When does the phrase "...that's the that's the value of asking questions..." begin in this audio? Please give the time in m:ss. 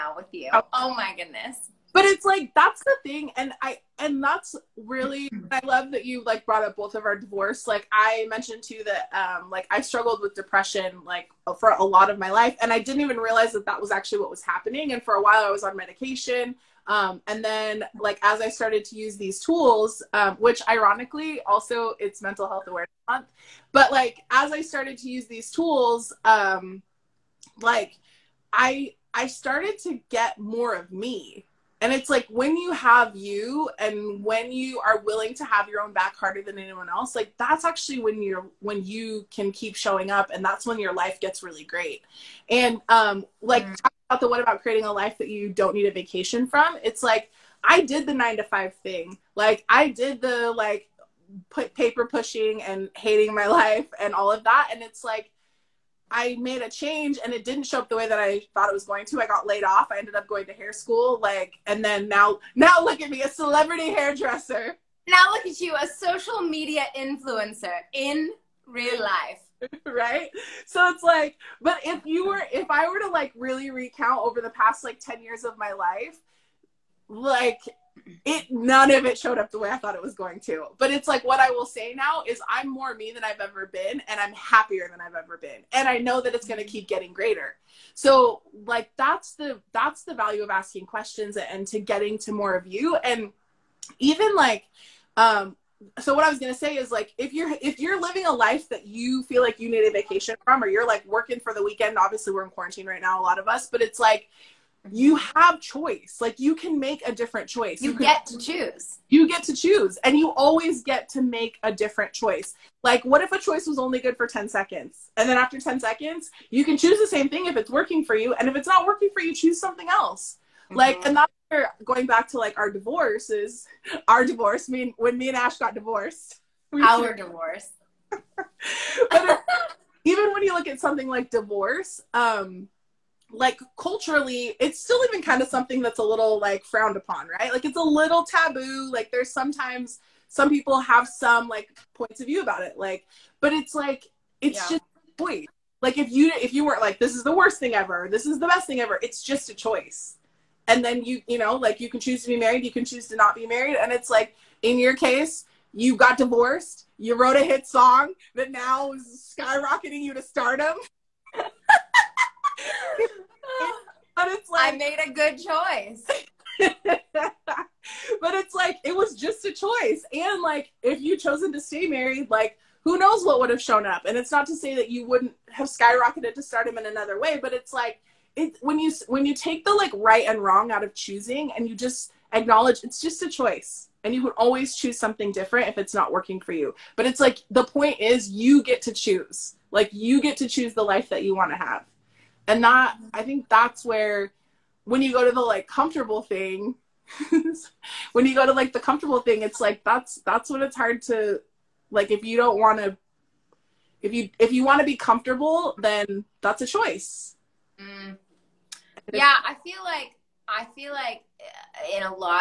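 1:28.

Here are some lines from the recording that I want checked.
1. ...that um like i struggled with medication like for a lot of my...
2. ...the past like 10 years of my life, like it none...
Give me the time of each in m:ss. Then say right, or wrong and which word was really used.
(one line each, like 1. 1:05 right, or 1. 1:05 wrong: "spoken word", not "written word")
1. 0:08 wrong: "depression", not "medication"
2. 1:14 right.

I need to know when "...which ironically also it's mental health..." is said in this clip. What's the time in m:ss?
0:20.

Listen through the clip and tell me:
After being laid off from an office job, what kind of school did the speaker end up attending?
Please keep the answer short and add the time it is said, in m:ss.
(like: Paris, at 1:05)
Hair school, at 1:00.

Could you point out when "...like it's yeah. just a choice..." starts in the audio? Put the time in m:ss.
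2:23.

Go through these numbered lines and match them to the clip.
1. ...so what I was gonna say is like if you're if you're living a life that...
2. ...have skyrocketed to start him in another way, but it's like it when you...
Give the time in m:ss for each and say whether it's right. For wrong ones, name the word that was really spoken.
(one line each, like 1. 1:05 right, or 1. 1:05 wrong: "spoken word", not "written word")
1. 1:35 right
2. 2:55 right.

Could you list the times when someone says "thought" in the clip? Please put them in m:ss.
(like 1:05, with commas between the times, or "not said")
0:58, 1:19.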